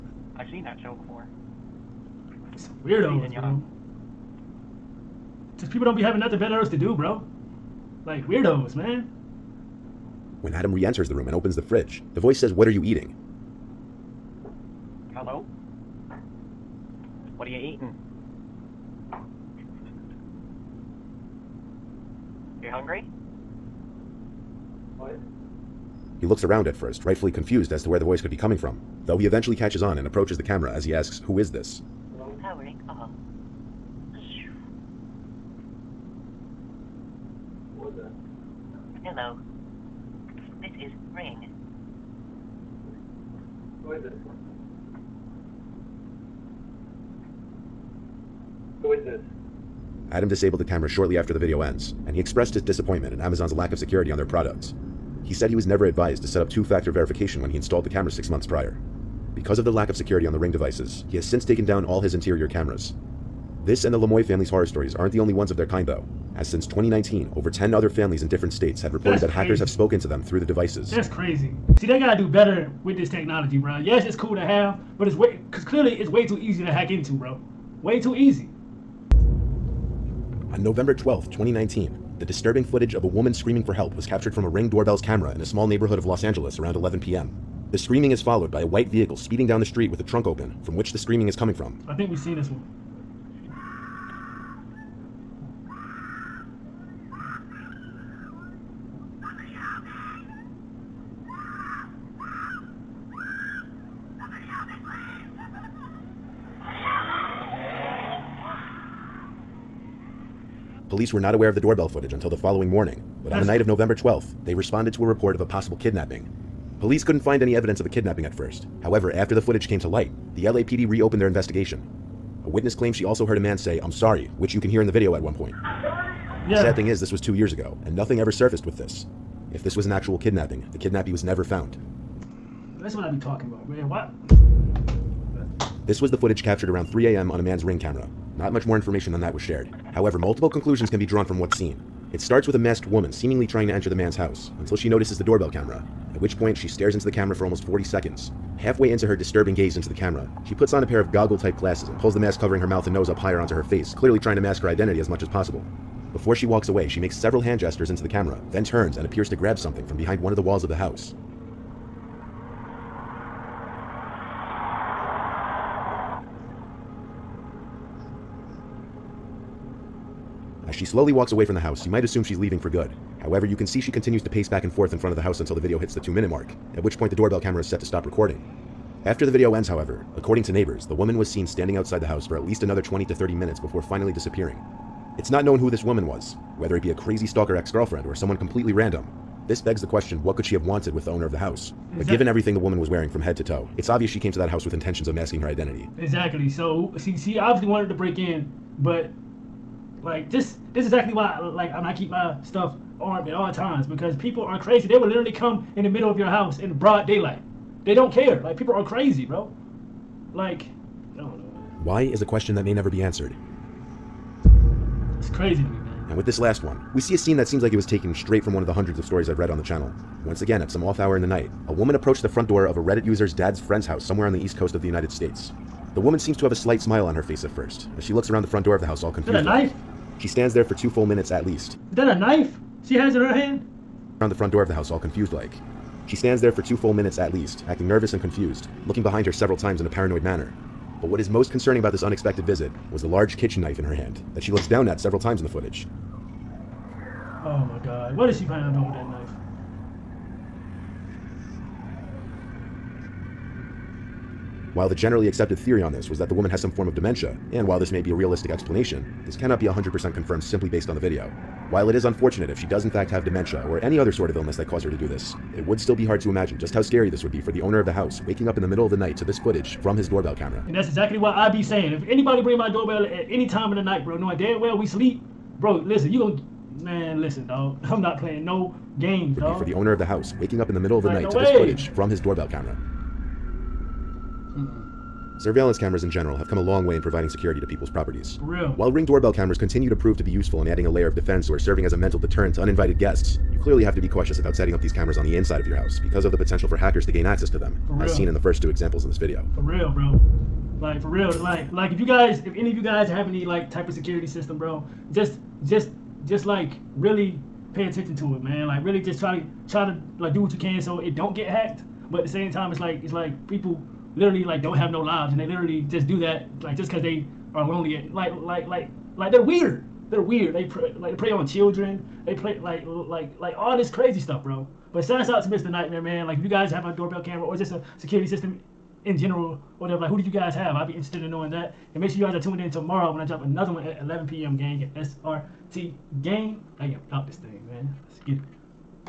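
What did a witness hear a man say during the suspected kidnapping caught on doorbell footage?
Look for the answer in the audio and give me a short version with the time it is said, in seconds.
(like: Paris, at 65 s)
I'm sorry, at 123 s.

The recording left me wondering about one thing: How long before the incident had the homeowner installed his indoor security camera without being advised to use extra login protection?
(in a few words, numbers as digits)
6 months.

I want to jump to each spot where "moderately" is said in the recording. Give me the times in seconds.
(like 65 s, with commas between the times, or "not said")
not said.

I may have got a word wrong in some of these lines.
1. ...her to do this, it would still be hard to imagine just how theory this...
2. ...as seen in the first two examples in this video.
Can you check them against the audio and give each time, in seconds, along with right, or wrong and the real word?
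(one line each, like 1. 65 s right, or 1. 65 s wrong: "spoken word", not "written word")
1. 264 s wrong: "scary", not "theory"
2. 297 s right.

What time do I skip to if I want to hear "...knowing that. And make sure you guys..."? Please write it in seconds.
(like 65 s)
331 s.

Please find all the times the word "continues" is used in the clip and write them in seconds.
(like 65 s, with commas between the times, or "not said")
173 s, 289 s.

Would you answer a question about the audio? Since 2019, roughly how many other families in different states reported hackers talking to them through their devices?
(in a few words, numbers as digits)
10.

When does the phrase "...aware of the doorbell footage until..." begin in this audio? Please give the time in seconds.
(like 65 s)
111 s.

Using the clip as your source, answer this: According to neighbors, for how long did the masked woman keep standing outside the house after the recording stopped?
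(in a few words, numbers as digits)
20 to 30 minutes.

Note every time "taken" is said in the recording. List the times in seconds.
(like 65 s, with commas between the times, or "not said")
61 s, 217 s.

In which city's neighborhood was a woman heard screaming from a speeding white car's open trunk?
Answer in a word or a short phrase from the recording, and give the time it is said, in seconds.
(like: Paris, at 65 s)
Los Angeles, at 86 s.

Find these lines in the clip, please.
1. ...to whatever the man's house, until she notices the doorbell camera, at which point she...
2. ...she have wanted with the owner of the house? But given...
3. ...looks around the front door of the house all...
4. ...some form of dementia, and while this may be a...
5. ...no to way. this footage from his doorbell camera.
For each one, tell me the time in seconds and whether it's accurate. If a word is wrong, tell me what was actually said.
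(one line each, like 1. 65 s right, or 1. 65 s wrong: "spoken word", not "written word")
1. 143 s wrong: "enter", not "whatever"
2. 190 s right
3. 228 s right
4. 256 s right
5. 281 s right.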